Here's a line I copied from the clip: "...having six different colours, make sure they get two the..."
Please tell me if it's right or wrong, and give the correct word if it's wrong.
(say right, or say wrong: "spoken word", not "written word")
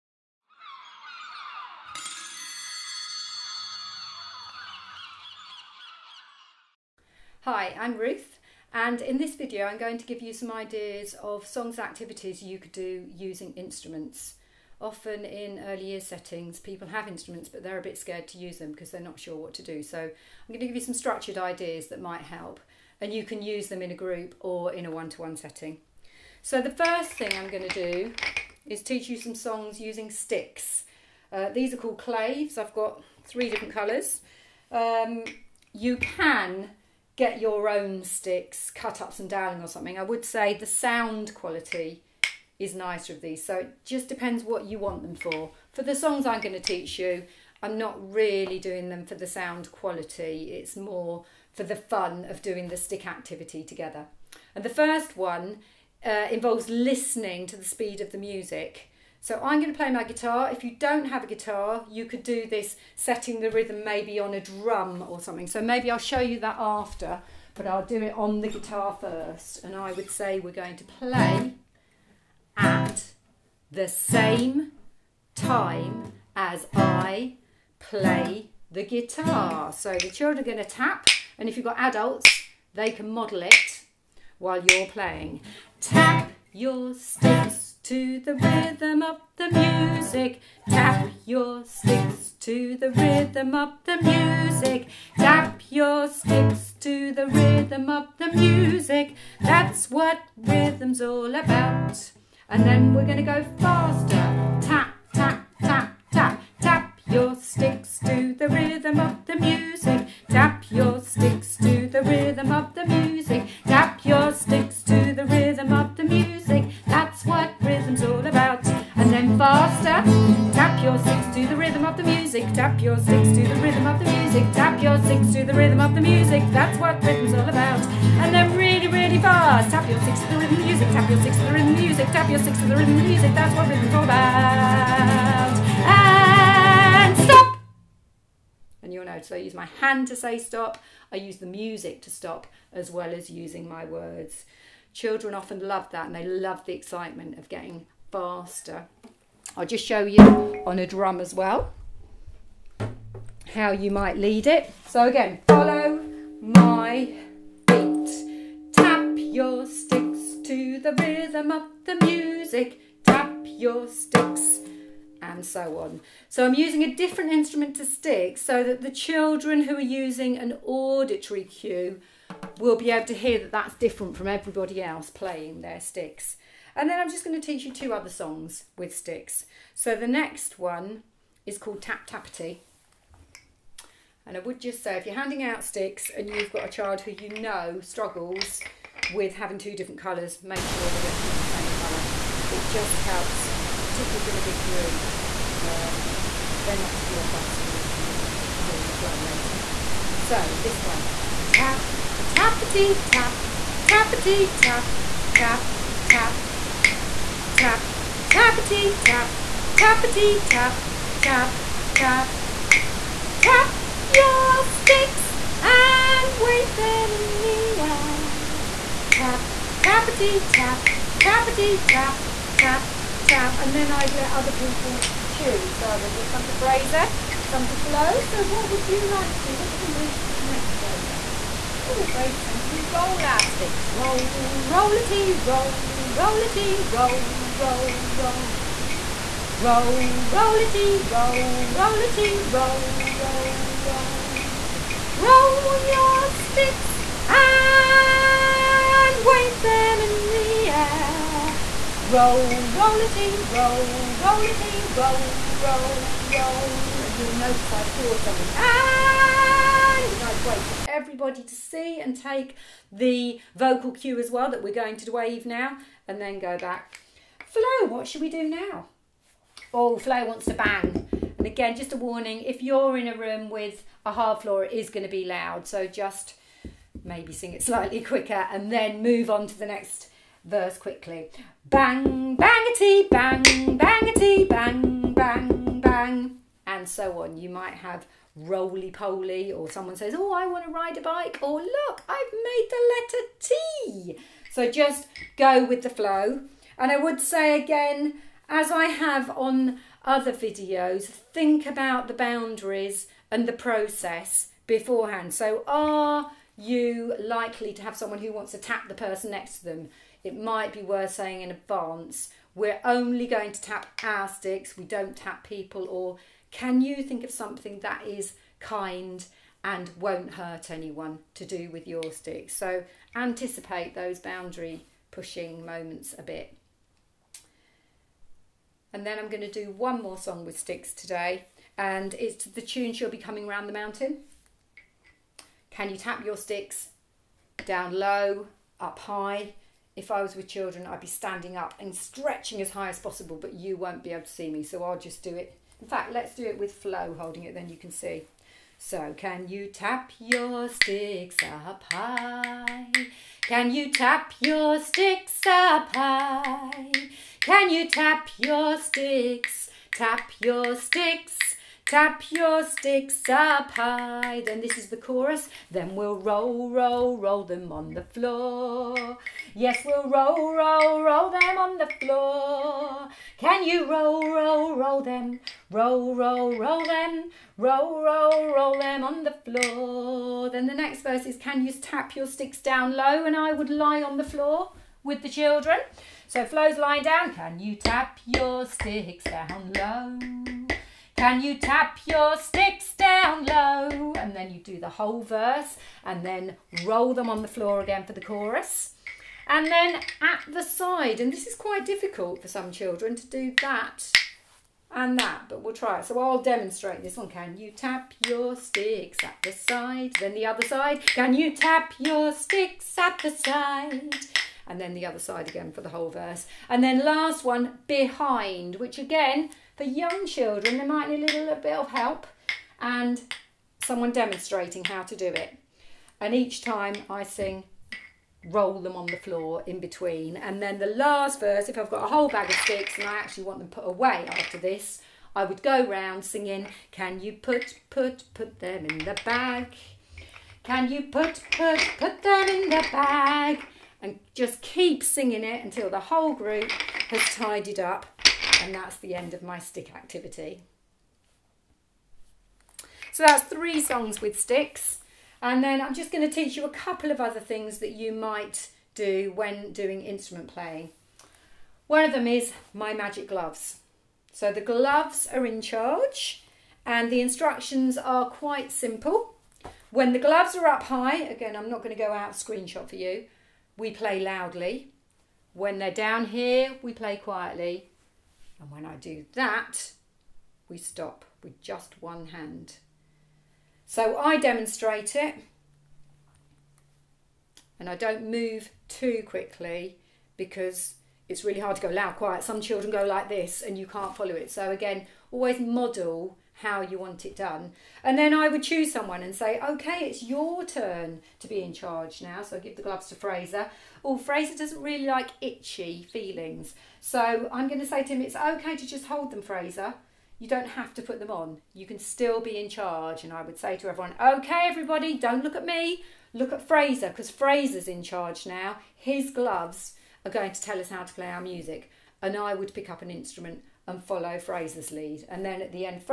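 wrong: "two", not "six".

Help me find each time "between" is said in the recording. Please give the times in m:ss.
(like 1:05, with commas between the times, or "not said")
7:09.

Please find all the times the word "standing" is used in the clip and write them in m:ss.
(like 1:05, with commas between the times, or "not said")
5:41.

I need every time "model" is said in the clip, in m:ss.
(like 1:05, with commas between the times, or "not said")
1:23, 8:15.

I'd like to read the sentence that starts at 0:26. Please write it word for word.
So the first thing I'm going to do is teach you some songs using sticks.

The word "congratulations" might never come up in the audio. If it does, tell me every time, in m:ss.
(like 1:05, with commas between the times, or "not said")
not said.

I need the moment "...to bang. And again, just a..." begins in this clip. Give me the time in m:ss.
4:30.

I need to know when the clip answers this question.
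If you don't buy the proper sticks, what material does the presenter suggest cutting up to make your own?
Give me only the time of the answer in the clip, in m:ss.
0:39.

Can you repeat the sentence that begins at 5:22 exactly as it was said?
So anticipate those boundary pushing moments a bit.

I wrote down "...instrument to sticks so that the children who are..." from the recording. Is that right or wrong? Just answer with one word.
right.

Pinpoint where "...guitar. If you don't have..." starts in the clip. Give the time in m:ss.
1:00.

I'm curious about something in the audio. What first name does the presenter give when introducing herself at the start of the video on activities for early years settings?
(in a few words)
Ruth.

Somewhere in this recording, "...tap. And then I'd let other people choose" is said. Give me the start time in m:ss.
3:43.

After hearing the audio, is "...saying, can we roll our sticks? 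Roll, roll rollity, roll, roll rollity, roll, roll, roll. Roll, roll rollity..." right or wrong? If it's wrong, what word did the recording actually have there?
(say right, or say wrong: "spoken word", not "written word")
right.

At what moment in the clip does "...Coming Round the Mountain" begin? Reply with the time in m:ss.
5:33.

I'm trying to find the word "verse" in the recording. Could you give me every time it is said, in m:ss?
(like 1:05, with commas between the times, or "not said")
4:40, 6:21, 6:35, 6:56, 7:11.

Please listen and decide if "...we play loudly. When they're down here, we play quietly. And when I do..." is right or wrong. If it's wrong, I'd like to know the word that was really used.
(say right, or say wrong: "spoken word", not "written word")
right.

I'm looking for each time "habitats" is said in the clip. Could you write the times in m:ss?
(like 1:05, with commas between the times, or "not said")
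not said.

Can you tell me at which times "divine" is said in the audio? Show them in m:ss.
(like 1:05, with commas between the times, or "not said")
not said.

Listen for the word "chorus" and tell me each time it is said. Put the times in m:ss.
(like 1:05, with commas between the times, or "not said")
6:04, 6:38.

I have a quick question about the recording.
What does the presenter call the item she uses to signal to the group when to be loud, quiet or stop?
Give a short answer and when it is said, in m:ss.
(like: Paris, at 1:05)
magic gloves, at 7:42.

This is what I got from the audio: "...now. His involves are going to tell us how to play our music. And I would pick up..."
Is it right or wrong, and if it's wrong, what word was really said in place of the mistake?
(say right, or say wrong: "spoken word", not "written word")
wrong: "gloves", not "involves".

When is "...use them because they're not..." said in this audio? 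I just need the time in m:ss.
0:18.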